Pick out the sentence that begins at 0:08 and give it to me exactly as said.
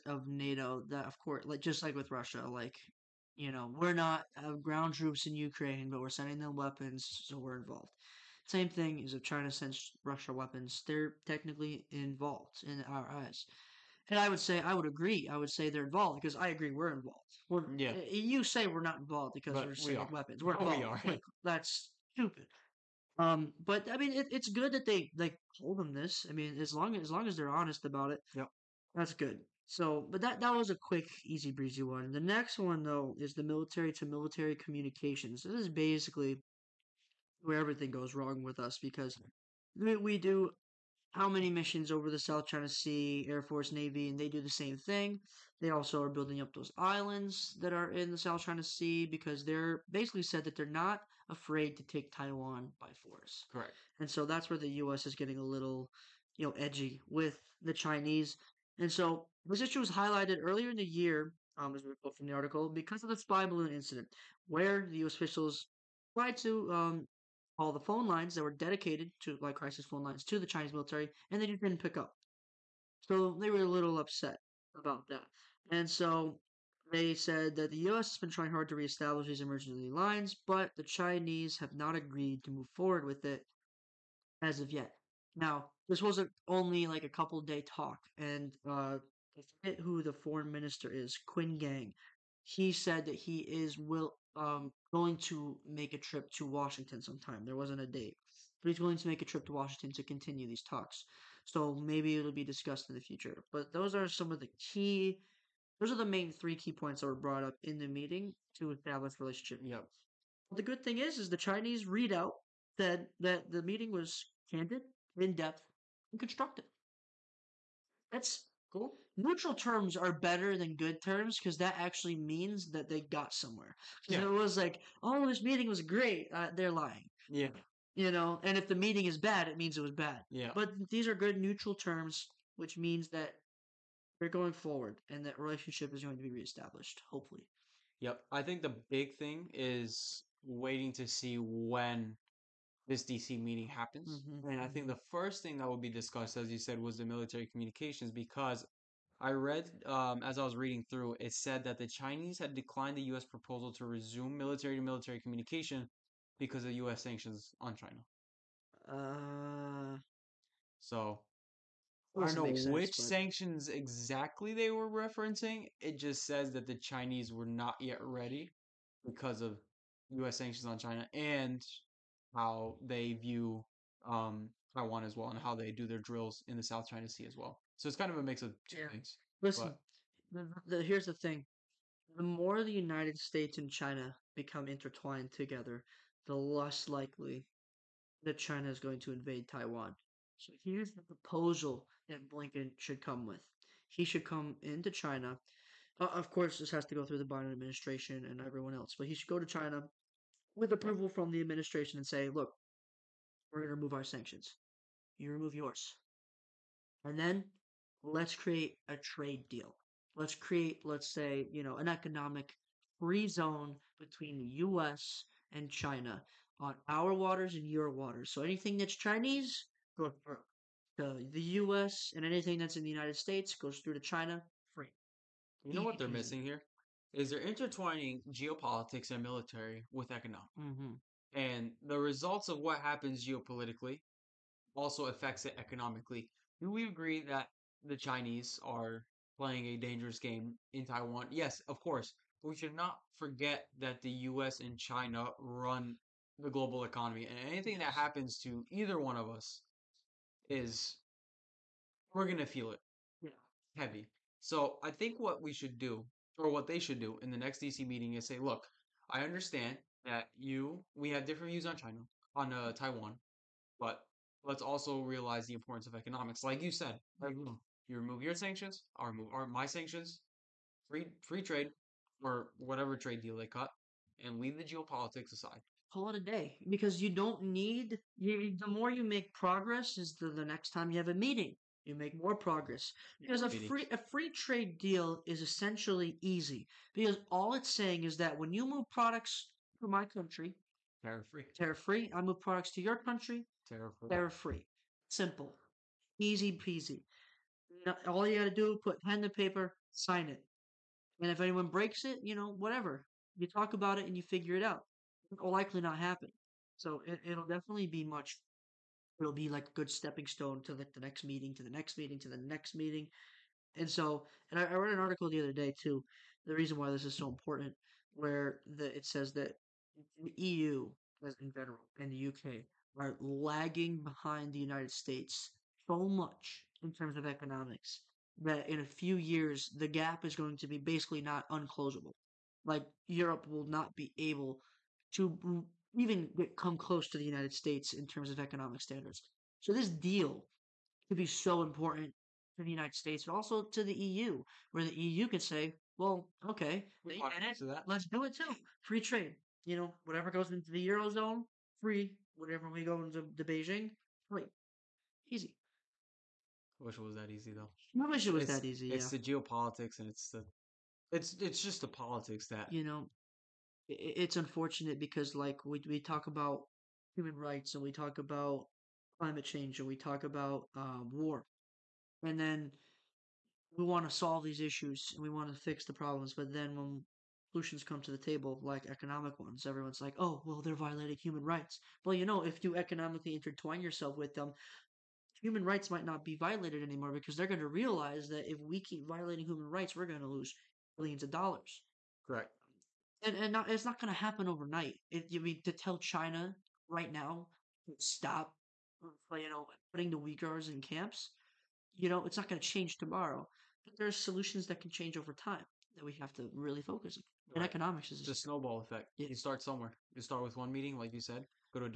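Same thing is if China sends Russia weapons, they're technically involved in our eyes.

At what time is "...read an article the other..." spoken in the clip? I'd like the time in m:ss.
5:14.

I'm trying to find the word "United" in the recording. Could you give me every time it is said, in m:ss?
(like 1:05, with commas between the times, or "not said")
3:02, 3:42, 5:24, 5:37, 5:42.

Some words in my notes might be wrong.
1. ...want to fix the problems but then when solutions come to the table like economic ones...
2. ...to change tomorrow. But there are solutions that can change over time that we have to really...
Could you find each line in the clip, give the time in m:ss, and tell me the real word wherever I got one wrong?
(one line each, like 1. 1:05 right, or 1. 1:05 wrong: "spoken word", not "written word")
1. 6:15 right
2. 6:42 right.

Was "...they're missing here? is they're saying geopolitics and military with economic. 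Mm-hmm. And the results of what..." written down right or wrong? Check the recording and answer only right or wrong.
wrong.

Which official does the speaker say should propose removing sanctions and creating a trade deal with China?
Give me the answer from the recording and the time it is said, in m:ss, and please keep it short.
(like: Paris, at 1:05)
Blinken, at 3:12.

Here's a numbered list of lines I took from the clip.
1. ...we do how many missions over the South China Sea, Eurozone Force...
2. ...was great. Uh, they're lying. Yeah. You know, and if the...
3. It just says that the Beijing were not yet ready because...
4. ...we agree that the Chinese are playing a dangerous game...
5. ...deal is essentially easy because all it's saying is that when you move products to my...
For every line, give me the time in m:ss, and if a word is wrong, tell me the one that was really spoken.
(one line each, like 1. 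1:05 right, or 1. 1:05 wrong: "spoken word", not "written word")
1. 0:39 wrong: "Air", not "Eurozone"
2. 2:05 right
3. 2:45 wrong: "Chinese", not "Beijing"
4. 3:56 right
5. 4:44 right.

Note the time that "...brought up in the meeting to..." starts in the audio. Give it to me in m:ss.
1:47.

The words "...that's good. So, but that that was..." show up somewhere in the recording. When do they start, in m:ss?
0:28.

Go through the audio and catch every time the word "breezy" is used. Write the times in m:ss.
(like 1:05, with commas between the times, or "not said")
0:31.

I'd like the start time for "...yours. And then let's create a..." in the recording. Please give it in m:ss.
3:25.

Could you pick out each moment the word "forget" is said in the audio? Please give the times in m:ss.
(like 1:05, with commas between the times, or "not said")
1:29, 4:03.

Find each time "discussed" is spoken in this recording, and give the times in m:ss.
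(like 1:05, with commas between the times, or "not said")
1:42, 2:25.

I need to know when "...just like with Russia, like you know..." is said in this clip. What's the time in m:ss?
0:01.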